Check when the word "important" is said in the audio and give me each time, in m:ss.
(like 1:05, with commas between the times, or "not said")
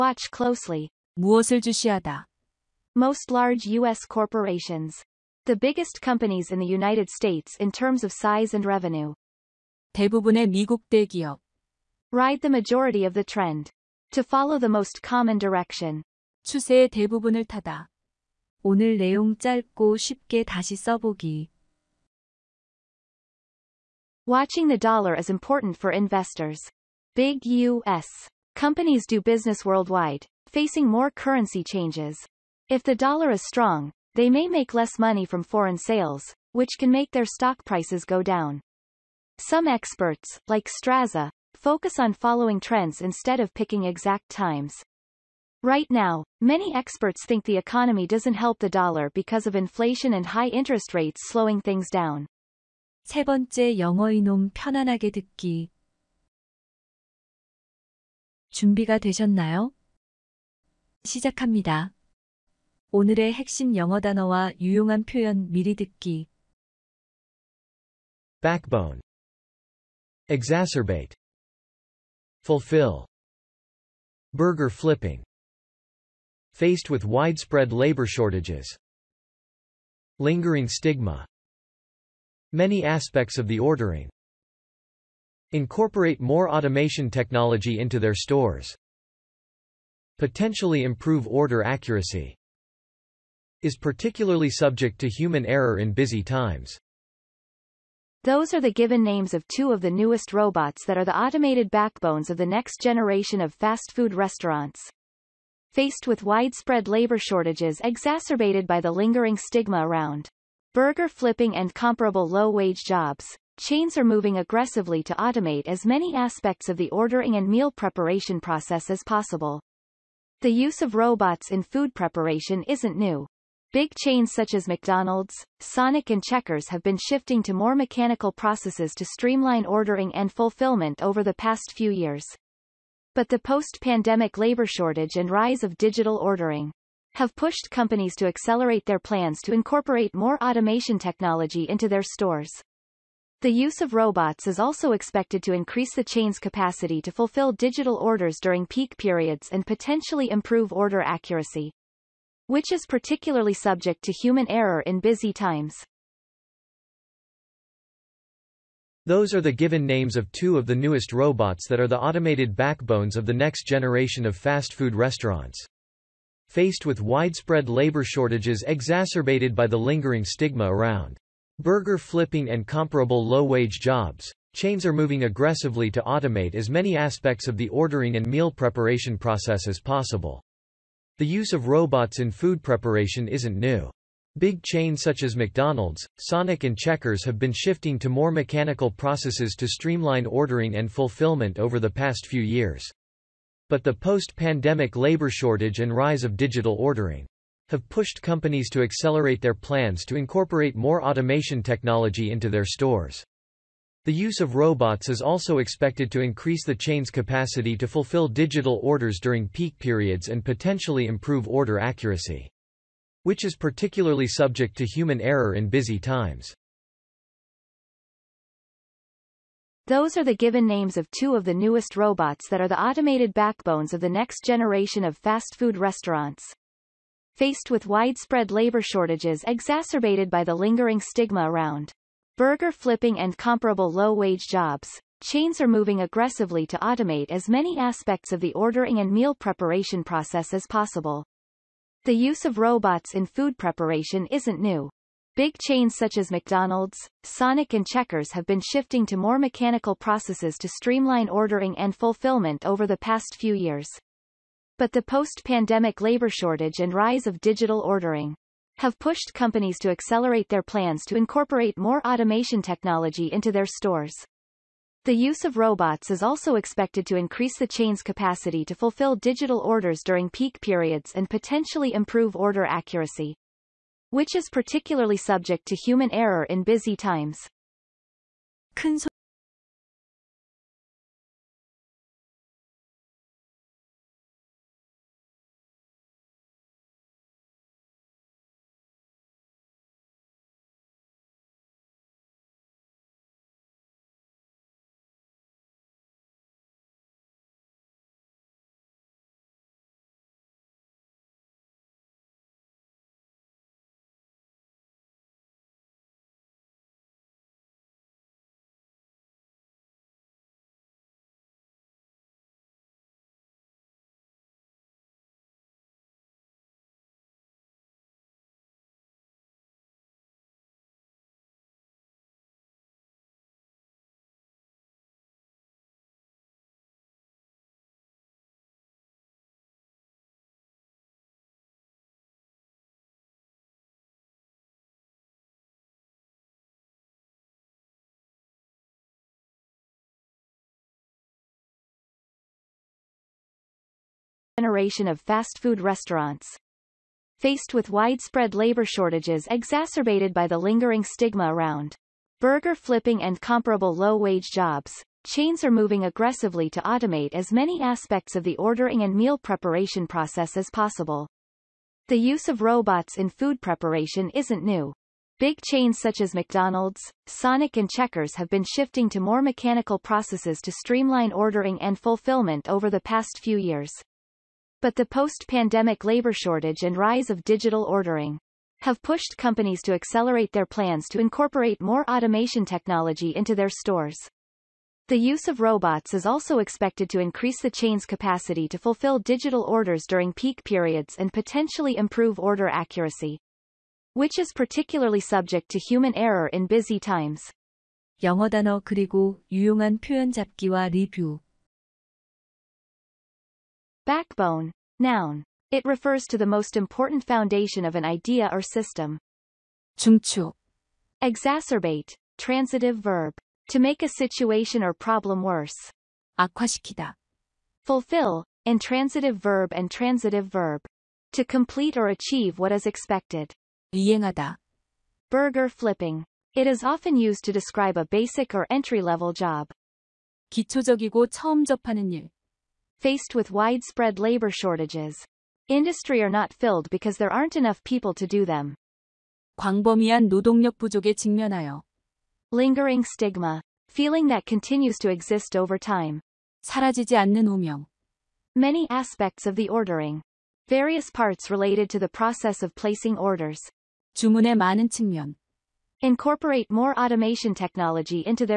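0:25, 6:46.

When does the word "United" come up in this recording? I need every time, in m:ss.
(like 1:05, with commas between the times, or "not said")
0:06.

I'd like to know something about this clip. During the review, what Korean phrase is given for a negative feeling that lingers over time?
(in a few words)
사라지지 않는 오명.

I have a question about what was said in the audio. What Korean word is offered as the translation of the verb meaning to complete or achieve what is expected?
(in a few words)
이행하다.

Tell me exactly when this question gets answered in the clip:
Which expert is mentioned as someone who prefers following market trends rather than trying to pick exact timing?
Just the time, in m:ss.
0:40.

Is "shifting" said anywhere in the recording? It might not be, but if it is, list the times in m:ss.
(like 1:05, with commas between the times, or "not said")
2:06, 3:07, 4:08, 6:08.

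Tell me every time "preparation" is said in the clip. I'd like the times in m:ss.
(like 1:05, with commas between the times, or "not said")
1:57, 2:01, 2:58, 3:02, 3:59, 4:03, 5:59, 6:03.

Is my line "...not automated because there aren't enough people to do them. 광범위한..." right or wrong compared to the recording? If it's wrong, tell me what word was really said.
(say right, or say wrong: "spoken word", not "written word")
wrong: "filled", not "automated".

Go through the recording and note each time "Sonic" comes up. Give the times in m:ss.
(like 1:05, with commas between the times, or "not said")
2:05, 3:06, 4:07, 6:07.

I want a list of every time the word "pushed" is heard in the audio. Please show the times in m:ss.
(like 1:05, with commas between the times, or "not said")
2:17, 3:17, 4:18, 6:19.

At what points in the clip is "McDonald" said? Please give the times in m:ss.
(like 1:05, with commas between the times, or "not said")
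2:04, 3:05, 4:06, 6:06.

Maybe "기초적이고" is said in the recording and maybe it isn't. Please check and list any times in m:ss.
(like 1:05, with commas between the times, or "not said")
7:10.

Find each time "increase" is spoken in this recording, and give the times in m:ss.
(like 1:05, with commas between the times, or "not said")
2:25, 3:26, 4:27, 6:27.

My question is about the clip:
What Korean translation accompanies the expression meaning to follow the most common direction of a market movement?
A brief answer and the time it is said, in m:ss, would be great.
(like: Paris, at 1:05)
추세의 대부분을 타다, at 0:16.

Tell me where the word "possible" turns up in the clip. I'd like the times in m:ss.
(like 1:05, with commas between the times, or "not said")
1:59, 2:59, 4:00, 6:00.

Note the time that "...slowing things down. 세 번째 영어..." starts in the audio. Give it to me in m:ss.
0:51.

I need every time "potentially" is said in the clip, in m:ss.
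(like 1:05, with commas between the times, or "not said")
1:30, 2:29, 3:30, 4:31, 6:31.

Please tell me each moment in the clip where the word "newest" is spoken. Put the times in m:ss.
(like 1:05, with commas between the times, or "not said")
1:39, 2:40, 3:41.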